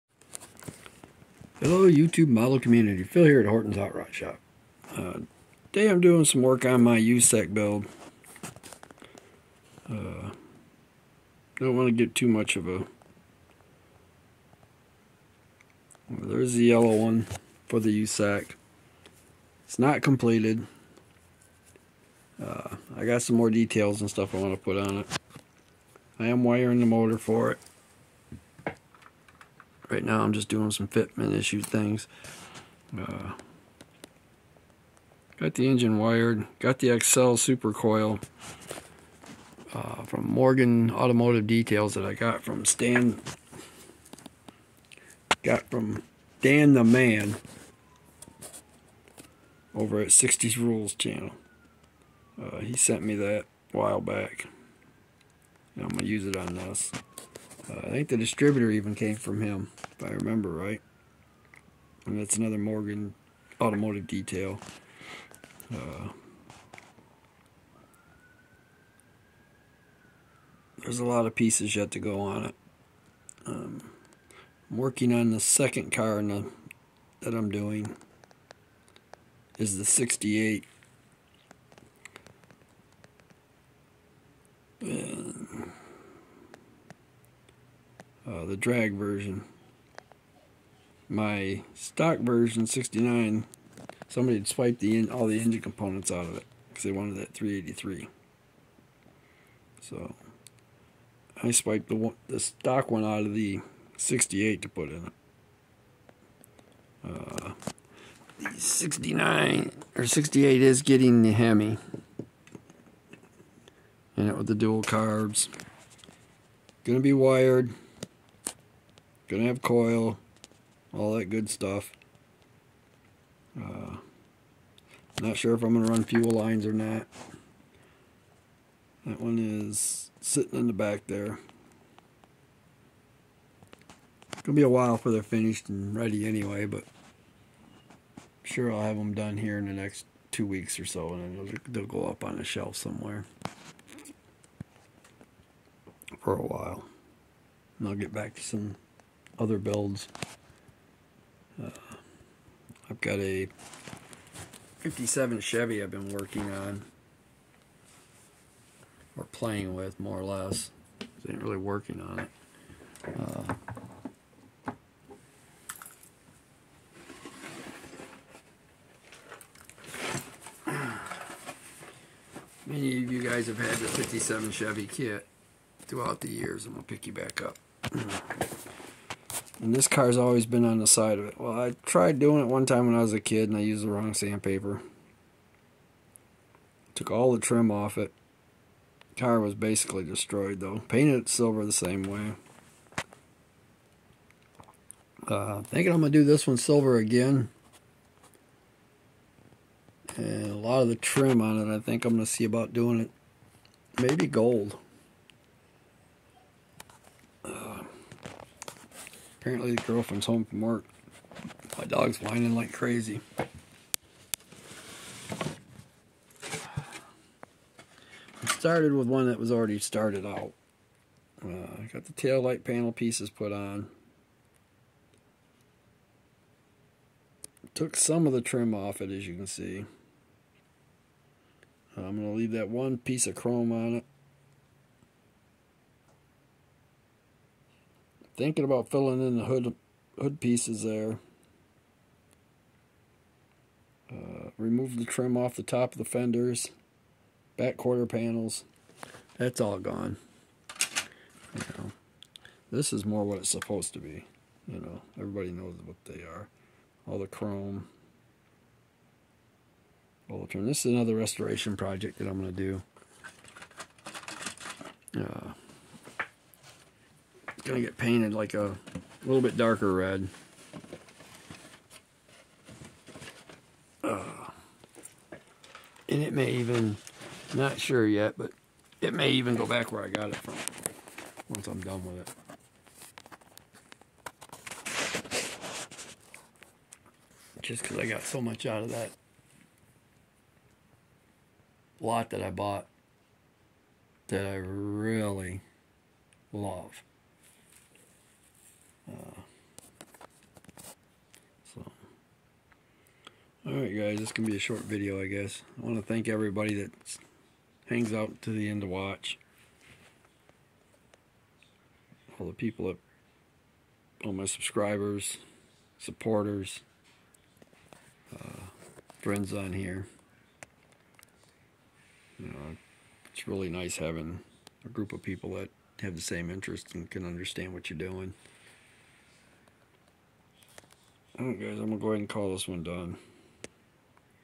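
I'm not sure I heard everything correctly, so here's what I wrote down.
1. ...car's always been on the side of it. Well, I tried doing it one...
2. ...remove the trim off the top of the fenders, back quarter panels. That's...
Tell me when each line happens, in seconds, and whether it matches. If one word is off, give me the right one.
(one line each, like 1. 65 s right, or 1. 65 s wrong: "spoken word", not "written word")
1. 179 s right
2. 244 s right.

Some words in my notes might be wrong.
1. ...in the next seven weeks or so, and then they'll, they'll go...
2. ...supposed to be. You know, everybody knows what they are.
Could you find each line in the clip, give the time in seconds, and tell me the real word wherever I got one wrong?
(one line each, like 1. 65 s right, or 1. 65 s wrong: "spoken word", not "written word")
1. 139 s wrong: "two", not "seven"
2. 253 s right.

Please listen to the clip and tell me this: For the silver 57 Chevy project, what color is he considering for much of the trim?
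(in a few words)
Gold.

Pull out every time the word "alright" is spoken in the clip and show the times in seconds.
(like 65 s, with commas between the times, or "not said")
303 s, 331 s.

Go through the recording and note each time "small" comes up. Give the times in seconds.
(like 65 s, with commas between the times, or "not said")
not said.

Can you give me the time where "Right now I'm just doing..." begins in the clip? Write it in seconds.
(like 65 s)
29 s.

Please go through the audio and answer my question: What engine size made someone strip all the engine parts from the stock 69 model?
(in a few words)
383.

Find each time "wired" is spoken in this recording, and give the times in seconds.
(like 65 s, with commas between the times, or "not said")
35 s, 117 s.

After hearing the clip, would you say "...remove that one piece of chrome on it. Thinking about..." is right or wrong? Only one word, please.
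wrong.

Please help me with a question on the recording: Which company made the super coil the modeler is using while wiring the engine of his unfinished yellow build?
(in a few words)
Morgan Automotive Details.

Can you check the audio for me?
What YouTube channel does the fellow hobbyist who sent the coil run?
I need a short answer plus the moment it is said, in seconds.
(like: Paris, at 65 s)
60s Rules, at 50 s.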